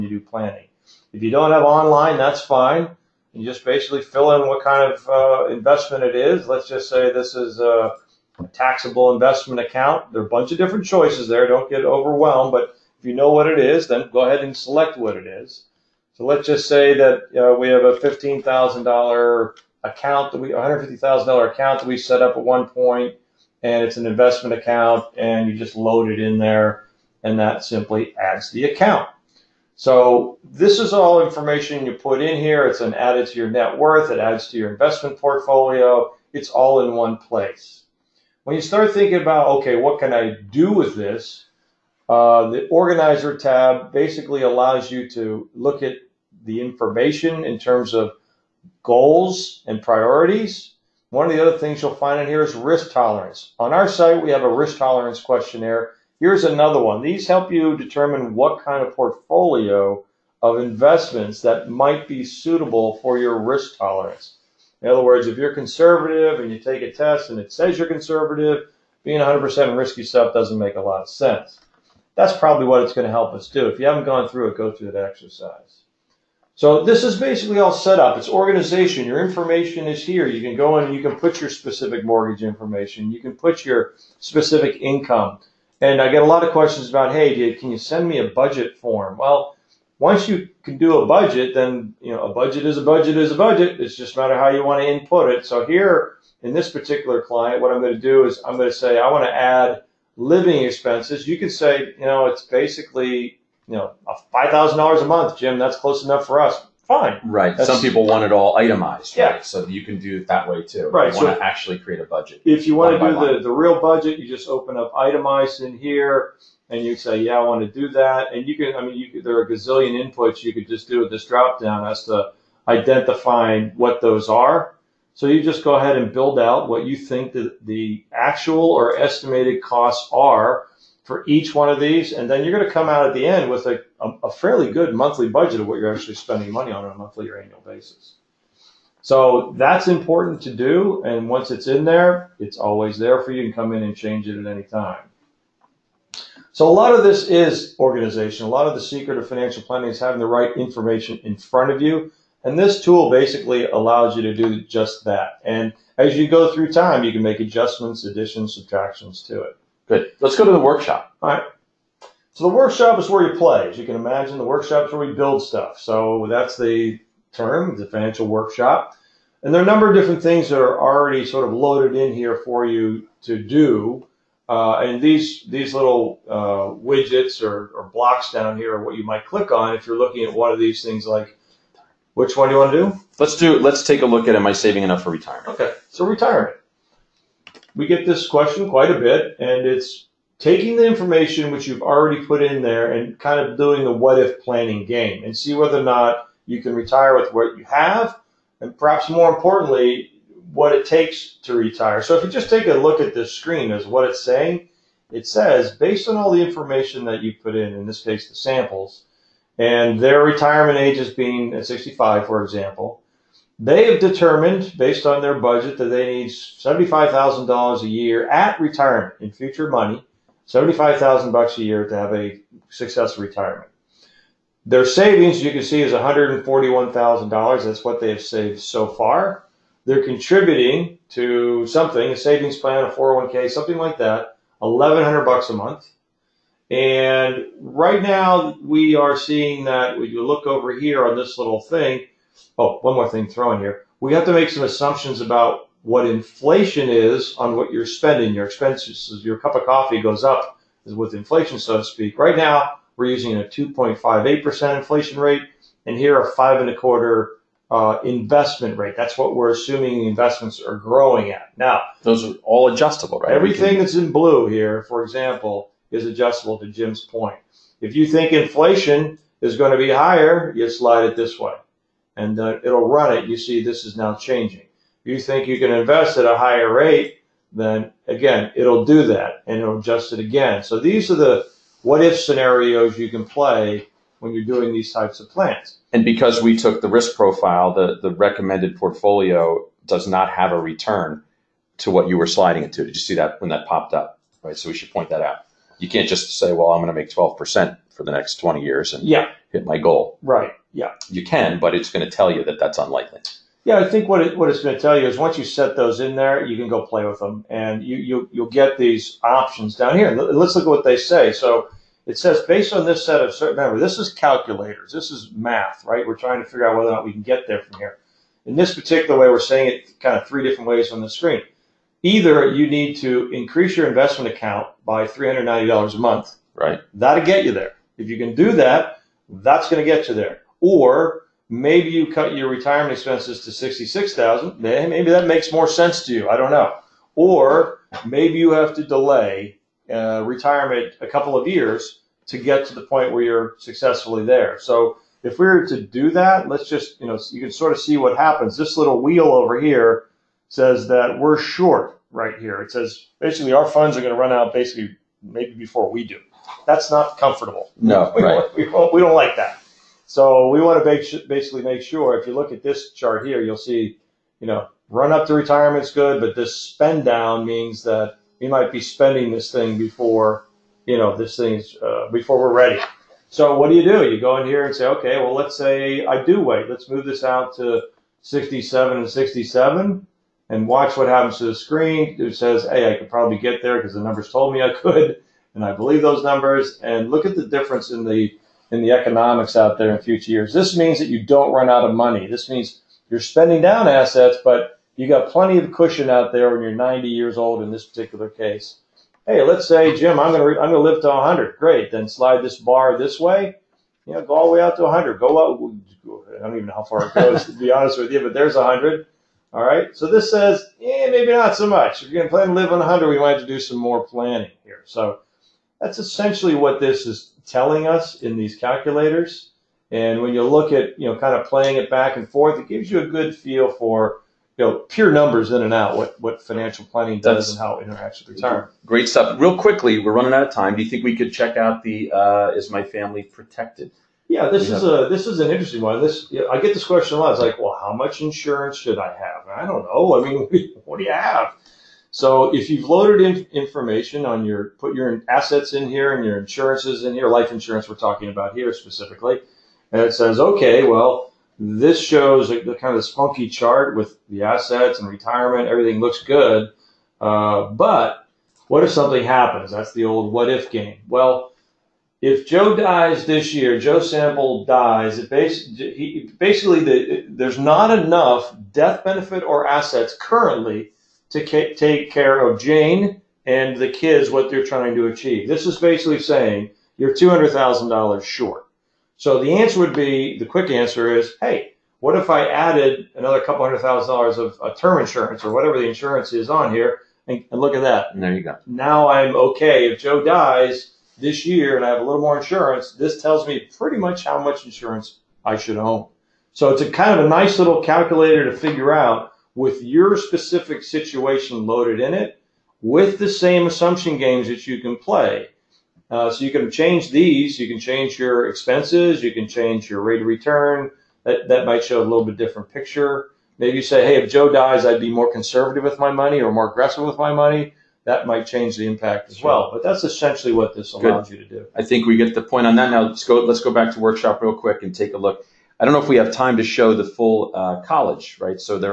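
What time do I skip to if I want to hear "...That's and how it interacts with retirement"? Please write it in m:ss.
7:07.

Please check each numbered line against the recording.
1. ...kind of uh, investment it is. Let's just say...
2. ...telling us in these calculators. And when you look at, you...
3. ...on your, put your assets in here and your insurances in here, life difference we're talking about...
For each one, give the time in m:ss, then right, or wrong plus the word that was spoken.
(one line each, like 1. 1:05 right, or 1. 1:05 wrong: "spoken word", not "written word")
1. 0:04 right
2. 6:57 right
3. 7:24 wrong: "insurance", not "difference".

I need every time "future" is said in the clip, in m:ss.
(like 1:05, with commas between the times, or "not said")
3:39, 6:30.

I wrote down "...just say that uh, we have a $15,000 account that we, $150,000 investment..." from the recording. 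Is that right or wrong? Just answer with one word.
wrong.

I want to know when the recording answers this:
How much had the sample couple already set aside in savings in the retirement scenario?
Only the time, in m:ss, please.
3:45.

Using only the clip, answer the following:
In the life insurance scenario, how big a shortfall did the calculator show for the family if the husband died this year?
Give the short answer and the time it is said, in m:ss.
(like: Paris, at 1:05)
$200,000, at 7:57.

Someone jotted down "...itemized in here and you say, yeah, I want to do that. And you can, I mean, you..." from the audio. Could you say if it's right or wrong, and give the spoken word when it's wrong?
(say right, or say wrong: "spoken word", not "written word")
right.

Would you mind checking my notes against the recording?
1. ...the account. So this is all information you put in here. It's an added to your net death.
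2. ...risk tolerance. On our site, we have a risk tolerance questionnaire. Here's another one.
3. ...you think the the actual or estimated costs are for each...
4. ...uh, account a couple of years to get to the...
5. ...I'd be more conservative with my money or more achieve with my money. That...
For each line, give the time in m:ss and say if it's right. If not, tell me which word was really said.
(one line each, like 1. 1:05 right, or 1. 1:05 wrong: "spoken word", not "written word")
1. 0:28 wrong: "worth", not "death"
2. 0:52 right
3. 2:06 right
4. 5:39 wrong: "retirement", not "account"
5. 8:34 wrong: "aggressive", not "achieve".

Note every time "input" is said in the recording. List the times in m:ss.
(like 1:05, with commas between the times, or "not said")
1:34, 2:00.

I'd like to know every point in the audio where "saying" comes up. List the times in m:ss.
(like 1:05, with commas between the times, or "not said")
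3:24, 5:19, 7:56.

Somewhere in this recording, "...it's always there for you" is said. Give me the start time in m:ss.
2:22.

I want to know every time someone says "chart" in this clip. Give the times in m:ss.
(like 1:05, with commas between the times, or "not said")
6:02, 7:33.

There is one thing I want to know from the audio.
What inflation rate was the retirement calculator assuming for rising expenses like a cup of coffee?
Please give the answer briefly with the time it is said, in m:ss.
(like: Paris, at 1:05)
2.58%, at 4:13.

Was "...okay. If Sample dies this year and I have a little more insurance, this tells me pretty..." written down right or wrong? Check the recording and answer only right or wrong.
wrong.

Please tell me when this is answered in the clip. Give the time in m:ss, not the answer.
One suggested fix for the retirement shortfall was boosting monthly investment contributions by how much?
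5:25.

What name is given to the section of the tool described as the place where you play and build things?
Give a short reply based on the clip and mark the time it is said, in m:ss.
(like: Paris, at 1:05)
the financial workshop, at 2:47.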